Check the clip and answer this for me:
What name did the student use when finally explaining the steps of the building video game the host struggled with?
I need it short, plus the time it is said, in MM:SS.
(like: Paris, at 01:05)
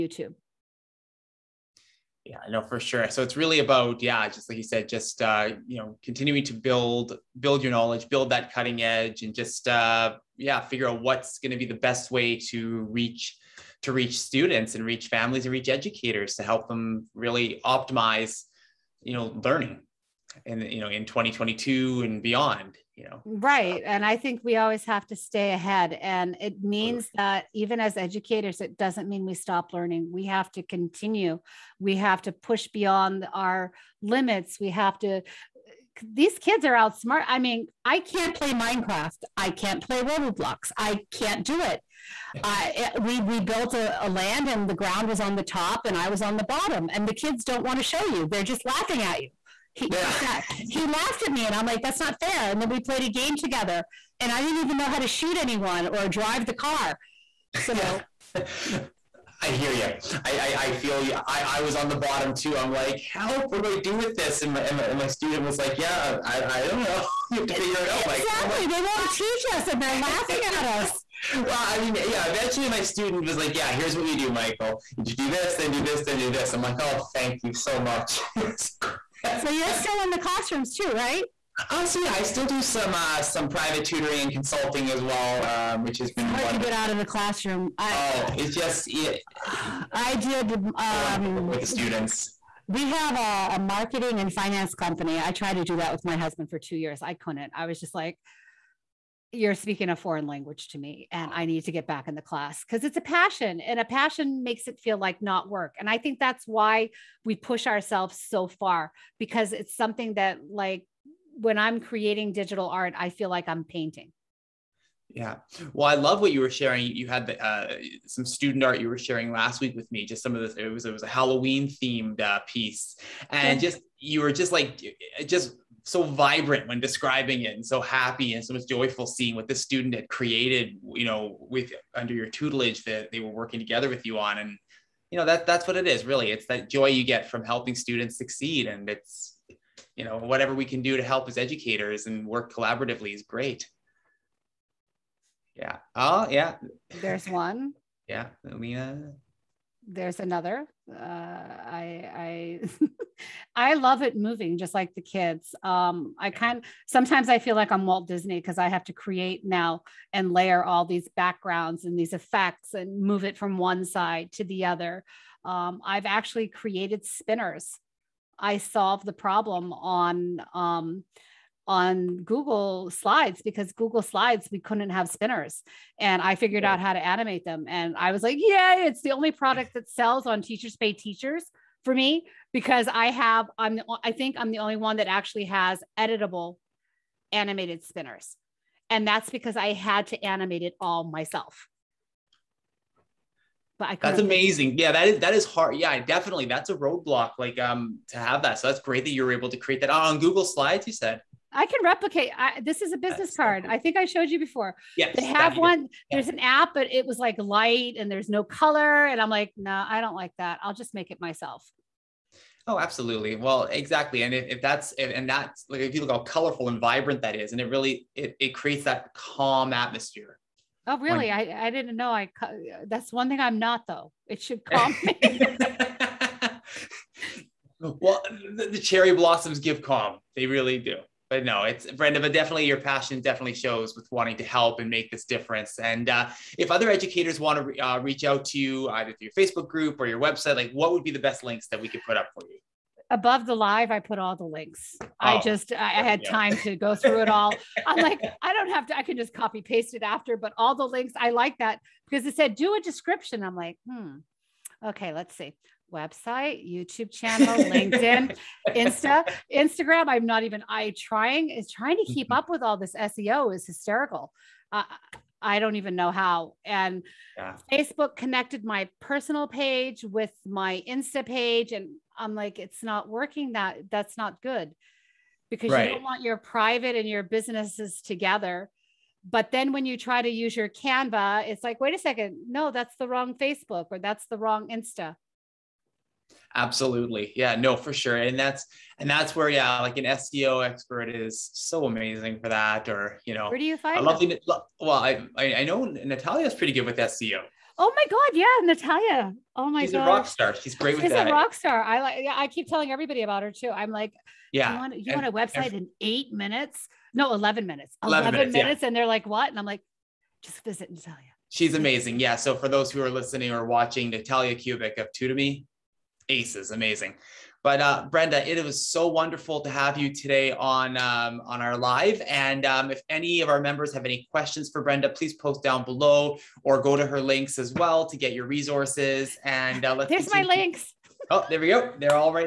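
Michael, at 01:14.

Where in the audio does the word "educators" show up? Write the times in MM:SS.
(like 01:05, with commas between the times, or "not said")
00:15, 00:27, 02:21, 03:56.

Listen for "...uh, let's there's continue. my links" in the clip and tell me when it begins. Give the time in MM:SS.
05:29.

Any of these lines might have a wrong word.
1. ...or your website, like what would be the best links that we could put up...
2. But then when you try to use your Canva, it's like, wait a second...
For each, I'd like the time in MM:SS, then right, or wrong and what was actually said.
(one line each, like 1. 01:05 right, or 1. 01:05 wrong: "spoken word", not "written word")
1. 04:00 right
2. 04:39 right.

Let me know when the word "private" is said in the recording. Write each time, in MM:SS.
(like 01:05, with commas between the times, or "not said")
01:23, 04:36.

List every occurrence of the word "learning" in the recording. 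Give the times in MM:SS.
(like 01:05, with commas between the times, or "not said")
00:19, 00:29.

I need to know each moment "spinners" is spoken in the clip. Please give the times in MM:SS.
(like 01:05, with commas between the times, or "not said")
02:47, 02:55, 03:07.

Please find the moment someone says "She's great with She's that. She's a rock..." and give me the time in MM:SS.
05:00.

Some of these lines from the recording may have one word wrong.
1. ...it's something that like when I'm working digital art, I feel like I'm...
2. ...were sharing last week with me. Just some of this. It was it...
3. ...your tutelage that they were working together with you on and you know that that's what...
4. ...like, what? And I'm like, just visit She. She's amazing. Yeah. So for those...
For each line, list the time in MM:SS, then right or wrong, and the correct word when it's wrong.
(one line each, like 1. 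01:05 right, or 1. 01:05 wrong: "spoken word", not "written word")
1. 01:49 wrong: "creating", not "working"
2. 01:58 right
3. 02:12 right
4. 05:09 wrong: "Natalia", not "She".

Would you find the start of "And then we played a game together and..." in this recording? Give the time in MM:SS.
00:52.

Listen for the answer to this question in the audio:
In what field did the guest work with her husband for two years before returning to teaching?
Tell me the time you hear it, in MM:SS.
01:33.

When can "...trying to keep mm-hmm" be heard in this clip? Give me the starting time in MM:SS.
04:21.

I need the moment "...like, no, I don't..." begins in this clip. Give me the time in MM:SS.
03:29.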